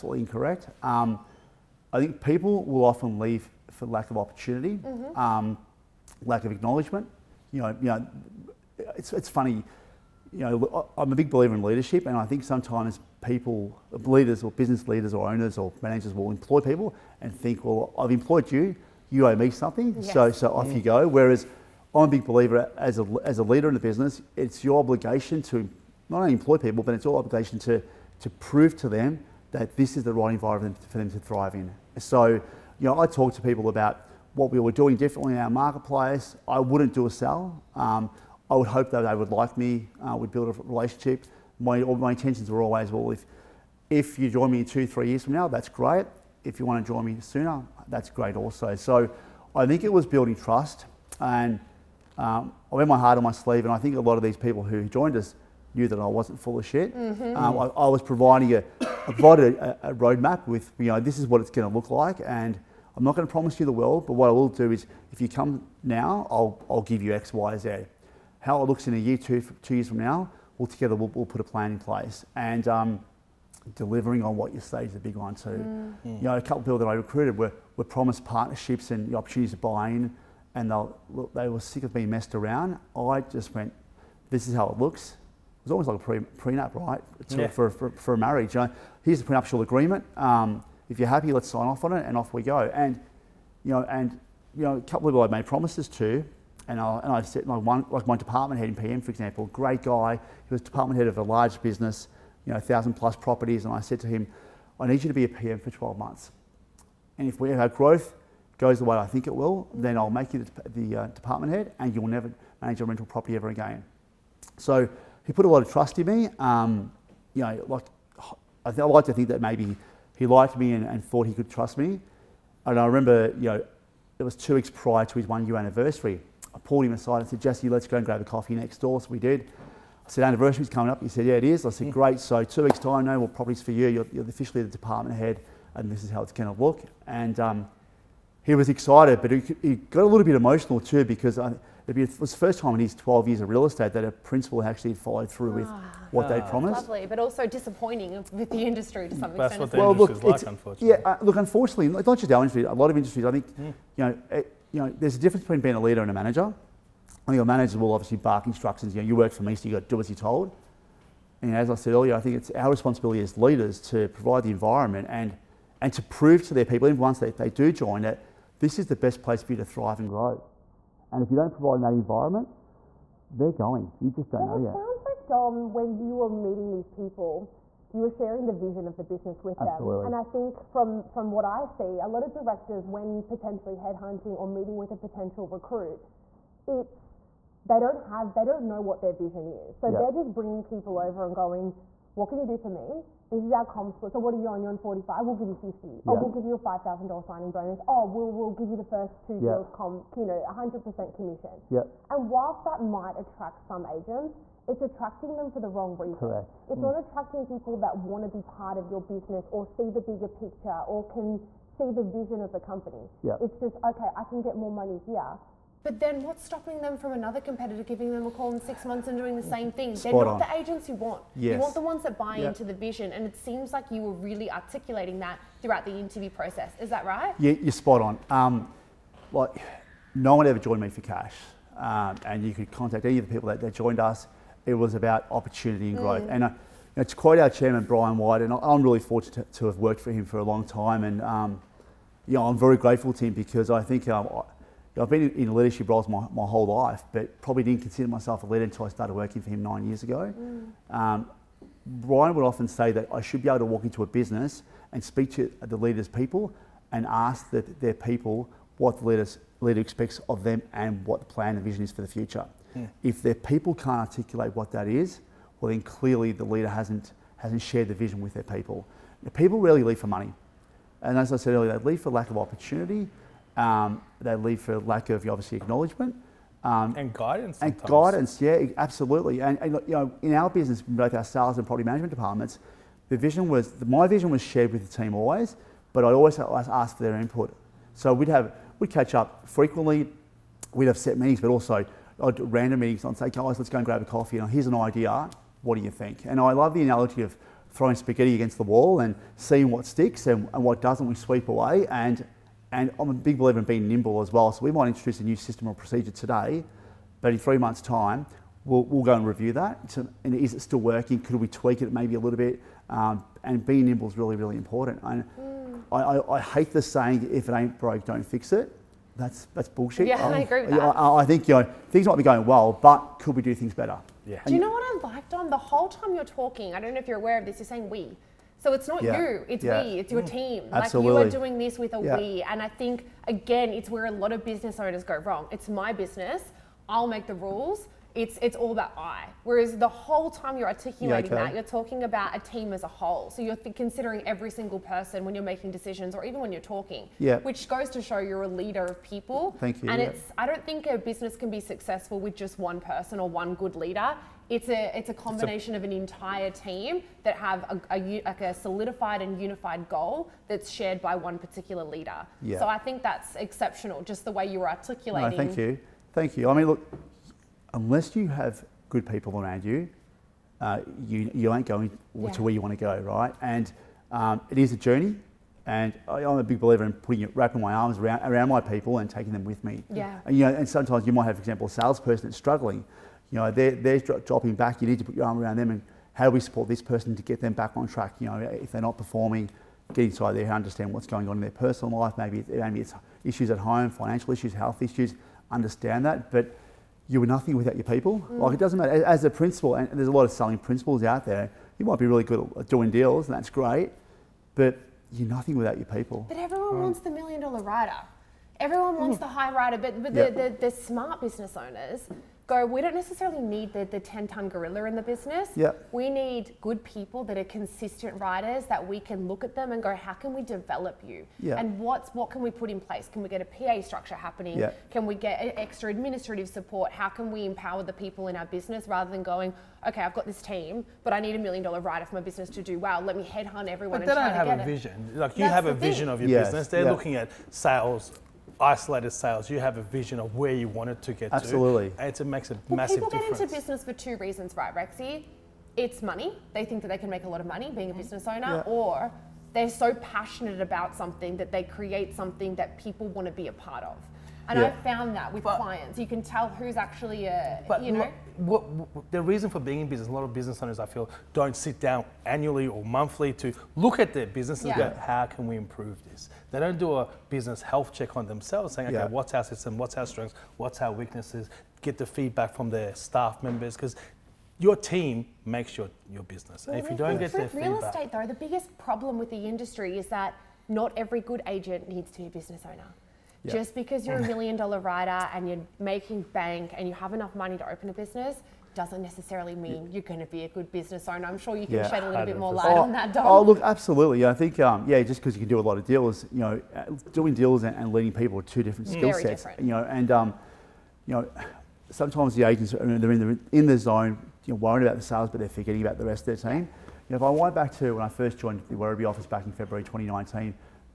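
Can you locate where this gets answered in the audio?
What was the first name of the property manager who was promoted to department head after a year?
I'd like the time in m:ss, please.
2:07.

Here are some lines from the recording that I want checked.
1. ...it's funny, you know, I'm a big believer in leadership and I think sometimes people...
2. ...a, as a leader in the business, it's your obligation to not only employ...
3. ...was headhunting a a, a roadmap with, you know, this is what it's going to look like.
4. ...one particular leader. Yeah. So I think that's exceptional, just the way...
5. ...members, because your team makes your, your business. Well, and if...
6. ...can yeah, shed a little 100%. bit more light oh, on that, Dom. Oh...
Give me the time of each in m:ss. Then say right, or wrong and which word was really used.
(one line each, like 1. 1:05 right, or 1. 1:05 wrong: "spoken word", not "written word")
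1. 0:09 right
2. 0:22 right
3. 0:57 wrong: "providing", not "headhunting"
4. 6:01 right
5. 7:53 right
6. 8:11 right.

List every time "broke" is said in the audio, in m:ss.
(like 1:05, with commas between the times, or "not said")
5:17.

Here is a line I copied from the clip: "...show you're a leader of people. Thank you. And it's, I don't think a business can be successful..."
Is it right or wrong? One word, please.
right.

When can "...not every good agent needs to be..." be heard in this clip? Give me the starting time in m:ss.
8:00.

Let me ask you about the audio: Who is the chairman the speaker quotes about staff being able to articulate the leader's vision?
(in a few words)
Brian White.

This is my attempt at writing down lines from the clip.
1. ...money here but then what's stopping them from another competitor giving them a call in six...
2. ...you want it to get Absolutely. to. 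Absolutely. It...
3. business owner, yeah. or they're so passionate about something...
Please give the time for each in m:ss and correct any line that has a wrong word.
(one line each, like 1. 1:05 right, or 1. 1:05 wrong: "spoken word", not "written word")
1. 3:34 right
2. 7:20 right
3. 7:28 right.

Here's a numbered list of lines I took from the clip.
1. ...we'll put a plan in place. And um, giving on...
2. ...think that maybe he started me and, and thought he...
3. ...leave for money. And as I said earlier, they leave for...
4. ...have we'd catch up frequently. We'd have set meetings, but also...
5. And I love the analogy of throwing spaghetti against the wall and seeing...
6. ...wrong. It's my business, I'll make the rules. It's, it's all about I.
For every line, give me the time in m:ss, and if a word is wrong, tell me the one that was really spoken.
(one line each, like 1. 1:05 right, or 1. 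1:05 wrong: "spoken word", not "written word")
1. 1:11 wrong: "delivering", not "giving"
2. 1:59 wrong: "liked", not "started"
3. 4:29 right
4. 4:48 right
5. 4:56 right
6. 5:35 right.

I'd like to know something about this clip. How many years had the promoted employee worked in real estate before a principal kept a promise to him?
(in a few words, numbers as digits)
12.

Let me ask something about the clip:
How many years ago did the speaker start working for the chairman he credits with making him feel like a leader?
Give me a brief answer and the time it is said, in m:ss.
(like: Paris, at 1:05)
9, at 4:09.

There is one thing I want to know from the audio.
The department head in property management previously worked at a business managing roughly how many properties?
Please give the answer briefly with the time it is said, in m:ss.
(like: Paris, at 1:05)
1,000+, at 1:42.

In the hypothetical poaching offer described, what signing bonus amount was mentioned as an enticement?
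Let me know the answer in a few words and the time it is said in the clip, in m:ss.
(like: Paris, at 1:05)
$5,000, at 3:16.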